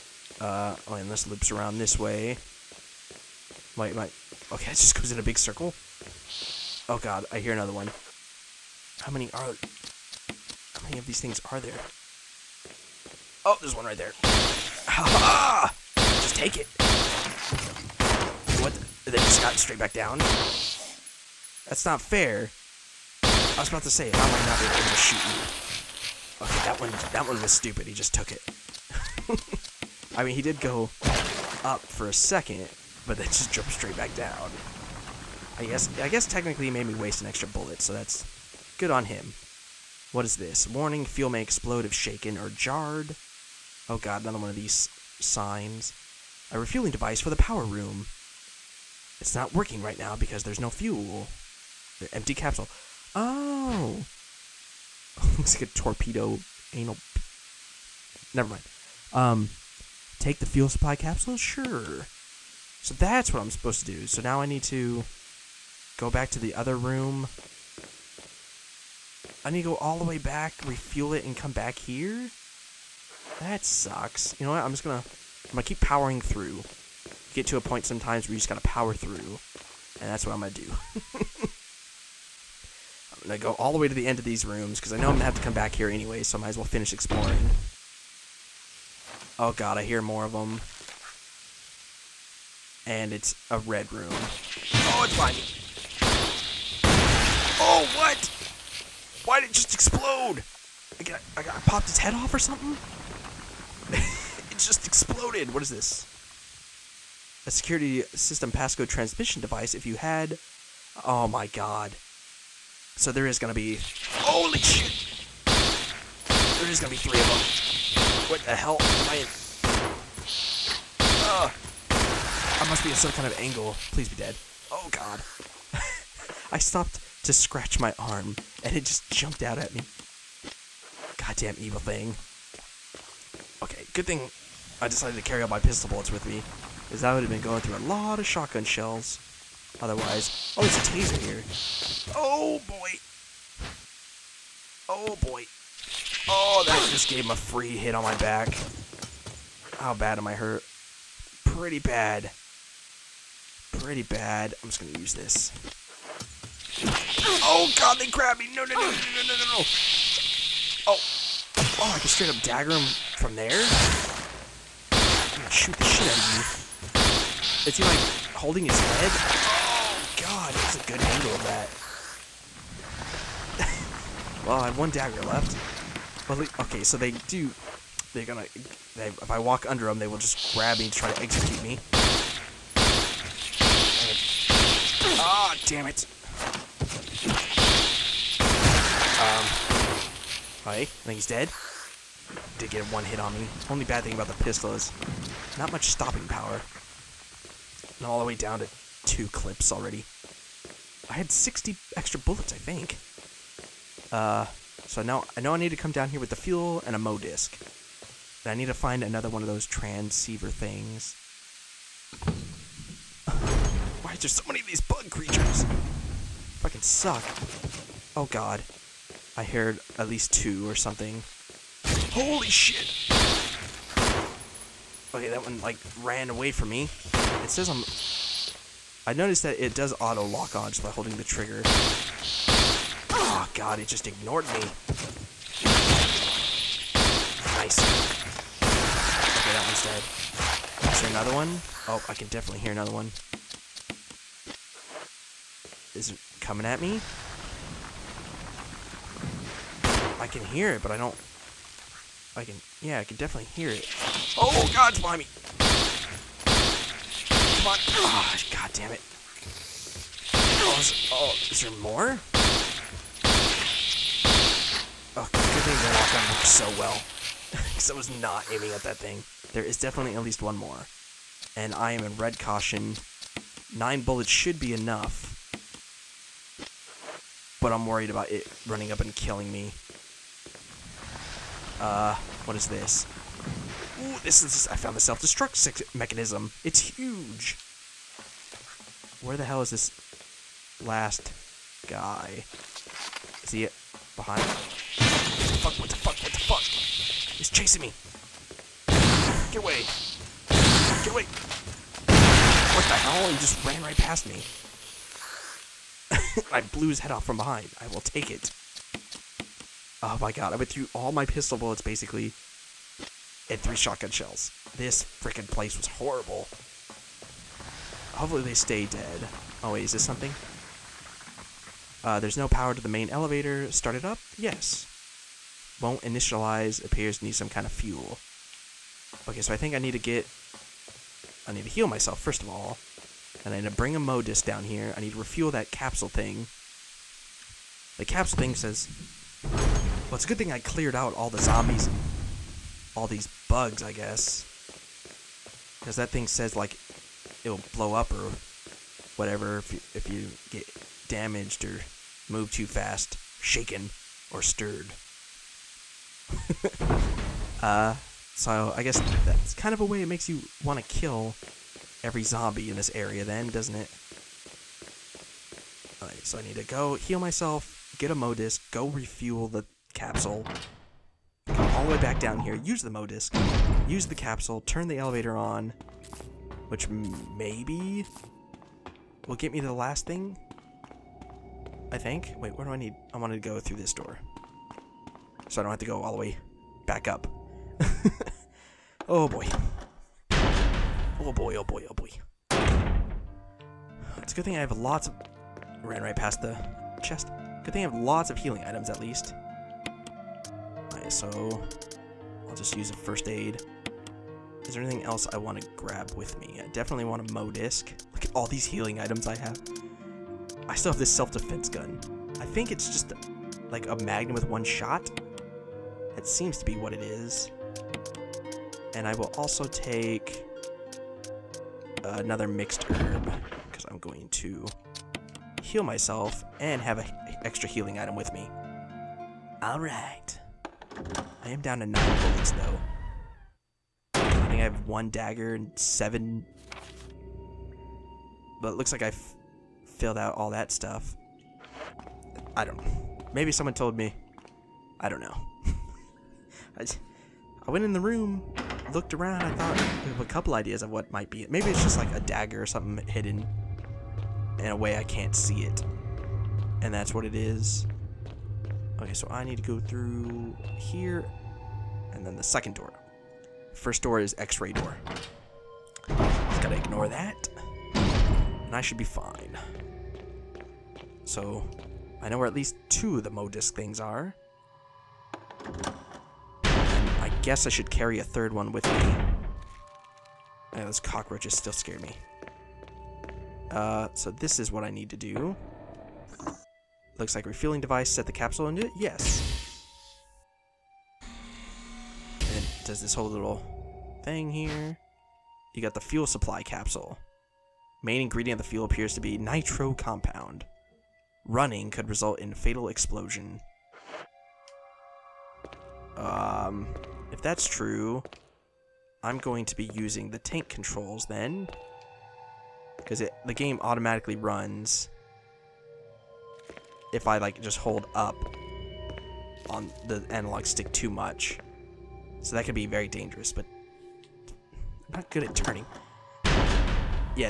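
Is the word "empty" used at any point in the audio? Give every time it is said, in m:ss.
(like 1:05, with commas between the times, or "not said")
0:52.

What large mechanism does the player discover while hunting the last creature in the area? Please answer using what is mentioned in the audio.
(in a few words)
self-destruct mechanism.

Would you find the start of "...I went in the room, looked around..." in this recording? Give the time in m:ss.
7:27.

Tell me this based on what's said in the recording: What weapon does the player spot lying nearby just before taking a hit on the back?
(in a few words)
taser.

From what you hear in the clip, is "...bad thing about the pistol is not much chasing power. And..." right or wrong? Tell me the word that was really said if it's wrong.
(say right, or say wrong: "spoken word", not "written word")
wrong: "stopping", not "chasing".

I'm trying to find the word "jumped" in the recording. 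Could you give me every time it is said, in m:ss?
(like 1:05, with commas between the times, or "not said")
0:33, 2:09.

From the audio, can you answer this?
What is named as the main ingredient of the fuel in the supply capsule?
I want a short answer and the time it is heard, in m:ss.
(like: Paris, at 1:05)
nitro compound, at 8:19.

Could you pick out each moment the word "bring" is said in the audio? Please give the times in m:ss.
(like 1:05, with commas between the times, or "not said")
5:33.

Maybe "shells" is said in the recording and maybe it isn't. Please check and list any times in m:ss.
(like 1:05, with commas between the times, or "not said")
2:18, 5:14.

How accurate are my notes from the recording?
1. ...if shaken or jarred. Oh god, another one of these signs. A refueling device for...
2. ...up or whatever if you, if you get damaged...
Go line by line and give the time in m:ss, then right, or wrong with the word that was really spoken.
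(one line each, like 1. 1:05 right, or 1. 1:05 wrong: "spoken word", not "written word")
1. 0:41 right
2. 5:47 right.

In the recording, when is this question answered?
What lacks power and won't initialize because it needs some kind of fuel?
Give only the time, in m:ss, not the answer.
5:22.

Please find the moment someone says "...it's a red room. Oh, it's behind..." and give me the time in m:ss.
1:33.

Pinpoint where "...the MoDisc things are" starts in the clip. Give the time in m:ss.
7:53.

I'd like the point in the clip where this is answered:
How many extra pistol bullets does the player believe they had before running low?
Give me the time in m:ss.
3:21.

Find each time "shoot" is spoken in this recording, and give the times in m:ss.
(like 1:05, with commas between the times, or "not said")
0:24, 2:45.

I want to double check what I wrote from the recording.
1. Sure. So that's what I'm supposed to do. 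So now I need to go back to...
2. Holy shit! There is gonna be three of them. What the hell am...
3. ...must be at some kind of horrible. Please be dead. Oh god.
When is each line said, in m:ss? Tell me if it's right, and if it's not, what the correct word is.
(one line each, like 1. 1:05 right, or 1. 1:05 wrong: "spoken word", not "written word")
1. 1:01 right
2. 1:54 right
3. 2:02 wrong: "angle", not "horrible".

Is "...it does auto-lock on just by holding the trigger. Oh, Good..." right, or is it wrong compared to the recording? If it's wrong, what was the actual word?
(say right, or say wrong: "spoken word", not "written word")
wrong: "God", not "Good".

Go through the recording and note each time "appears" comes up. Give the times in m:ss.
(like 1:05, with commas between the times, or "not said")
5:26, 8:18.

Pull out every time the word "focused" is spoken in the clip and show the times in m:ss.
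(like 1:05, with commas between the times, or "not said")
not said.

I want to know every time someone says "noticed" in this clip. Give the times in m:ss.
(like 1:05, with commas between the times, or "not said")
3:49.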